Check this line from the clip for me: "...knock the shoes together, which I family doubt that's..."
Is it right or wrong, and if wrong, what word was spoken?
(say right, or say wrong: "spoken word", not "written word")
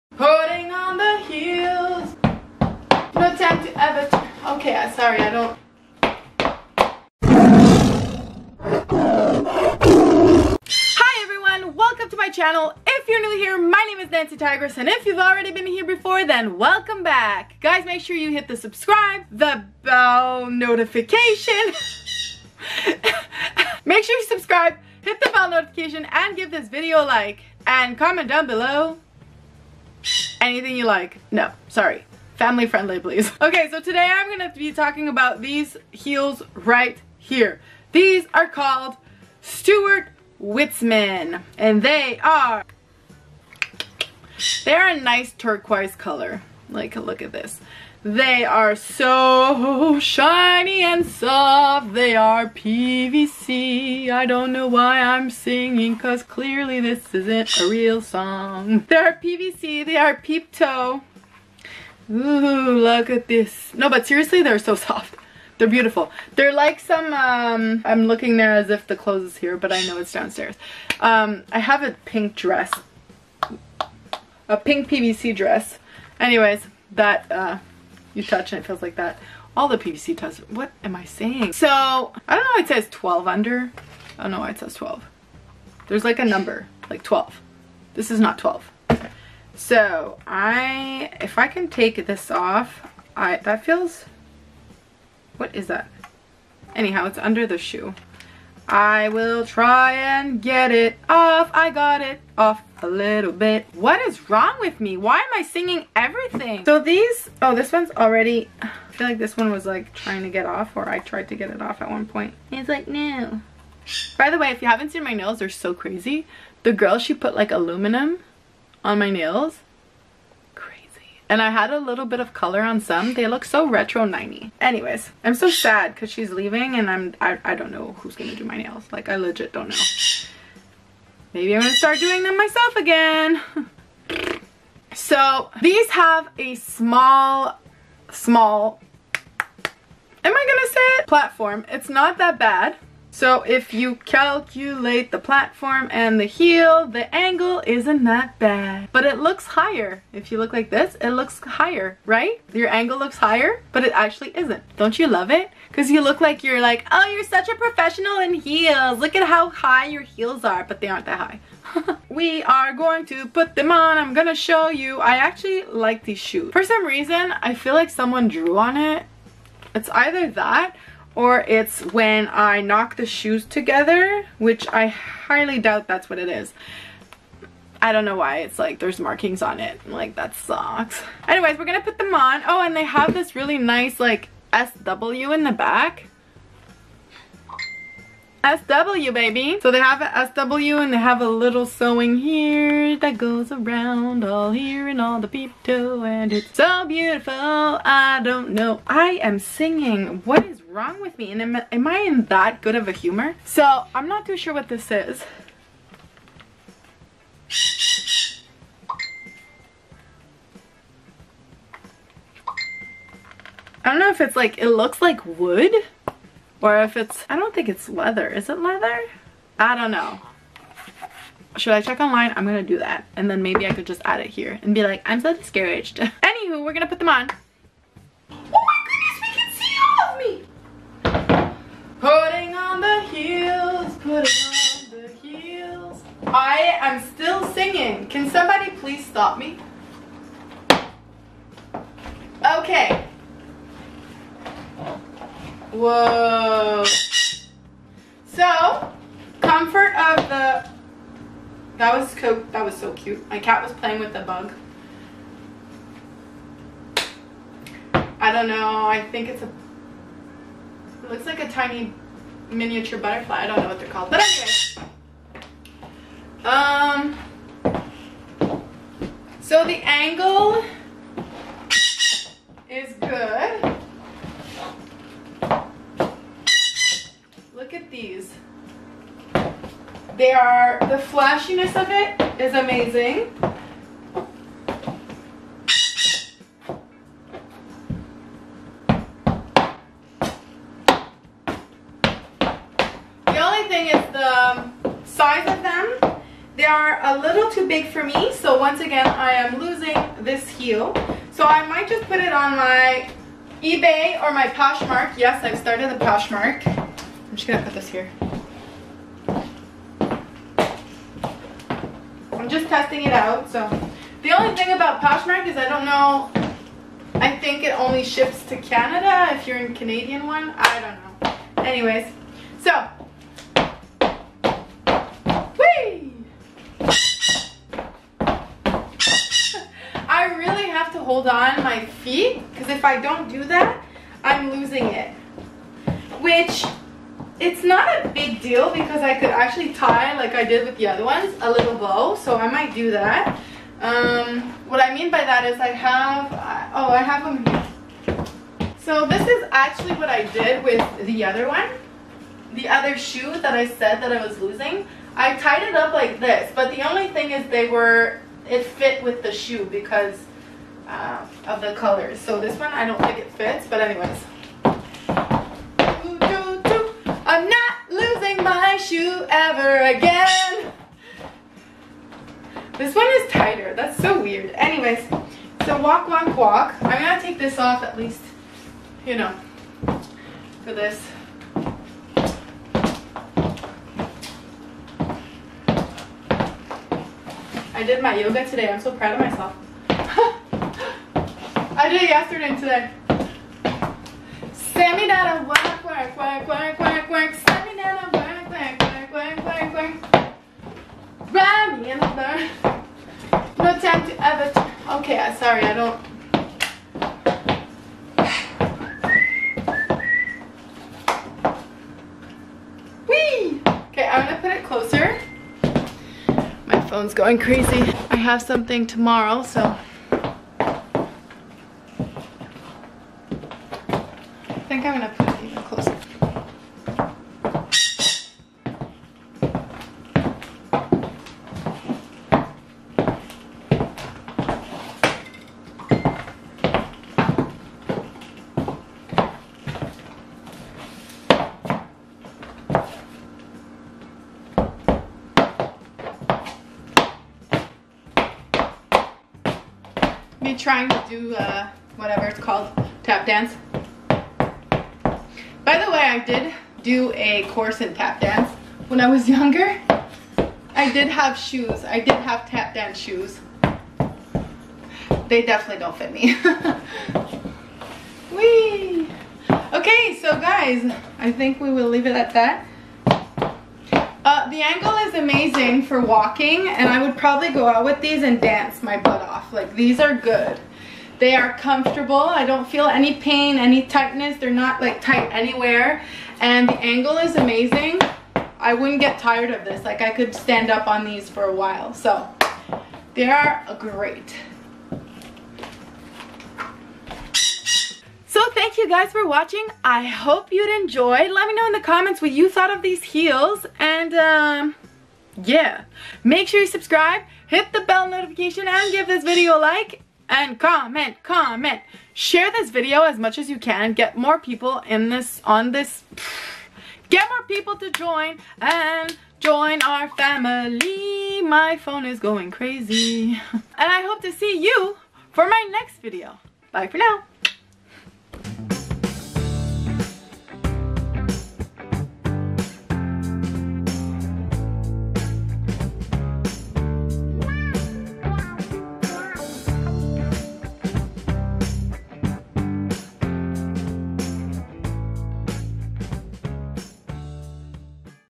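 wrong: "highly", not "family".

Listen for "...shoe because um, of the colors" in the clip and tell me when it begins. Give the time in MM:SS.
05:59.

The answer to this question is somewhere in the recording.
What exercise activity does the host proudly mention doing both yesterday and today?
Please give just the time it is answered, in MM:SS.
06:28.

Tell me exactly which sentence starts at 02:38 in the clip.
Look at how high your heels are, but they aren't that high.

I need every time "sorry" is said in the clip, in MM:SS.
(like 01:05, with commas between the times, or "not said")
00:04, 00:31, 06:45.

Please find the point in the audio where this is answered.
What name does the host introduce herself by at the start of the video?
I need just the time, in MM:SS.
00:14.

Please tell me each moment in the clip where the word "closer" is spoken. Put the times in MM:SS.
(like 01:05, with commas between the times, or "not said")
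06:54, 07:05.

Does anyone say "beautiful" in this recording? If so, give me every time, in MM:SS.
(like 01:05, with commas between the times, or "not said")
01:05, 03:16.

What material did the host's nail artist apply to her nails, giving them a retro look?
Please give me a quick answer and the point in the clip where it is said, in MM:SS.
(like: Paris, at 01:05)
Aluminum, at 01:57.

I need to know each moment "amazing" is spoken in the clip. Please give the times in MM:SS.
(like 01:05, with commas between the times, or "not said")
04:42, 07:55, 08:07.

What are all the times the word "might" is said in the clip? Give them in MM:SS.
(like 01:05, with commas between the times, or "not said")
05:01, 05:42.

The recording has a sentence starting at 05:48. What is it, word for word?
So this is actually what I did with the other one.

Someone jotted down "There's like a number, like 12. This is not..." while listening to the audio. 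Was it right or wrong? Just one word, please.
right.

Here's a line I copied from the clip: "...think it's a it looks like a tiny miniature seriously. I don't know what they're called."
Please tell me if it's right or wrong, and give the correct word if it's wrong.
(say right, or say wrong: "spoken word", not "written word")
wrong: "butterfly", not "seriously".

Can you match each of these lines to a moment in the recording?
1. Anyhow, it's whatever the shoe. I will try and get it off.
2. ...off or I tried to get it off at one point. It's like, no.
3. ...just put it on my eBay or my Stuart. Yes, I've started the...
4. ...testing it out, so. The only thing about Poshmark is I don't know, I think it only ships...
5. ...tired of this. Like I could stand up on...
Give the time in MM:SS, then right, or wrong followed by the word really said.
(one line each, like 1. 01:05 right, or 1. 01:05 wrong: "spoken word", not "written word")
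1. 01:36 wrong: "under", not "whatever"
2. 01:50 right
3. 05:01 wrong: "Poshmark", not "Stuart"
4. 05:12 right
5. 08:09 right.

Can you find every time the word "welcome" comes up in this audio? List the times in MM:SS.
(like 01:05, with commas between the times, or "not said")
00:11, 00:16.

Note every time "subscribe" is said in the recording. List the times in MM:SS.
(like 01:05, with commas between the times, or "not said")
00:18, 00:24, 08:26.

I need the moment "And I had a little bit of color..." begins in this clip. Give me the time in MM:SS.
02:01.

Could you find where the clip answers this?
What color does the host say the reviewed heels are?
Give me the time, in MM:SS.
00:45.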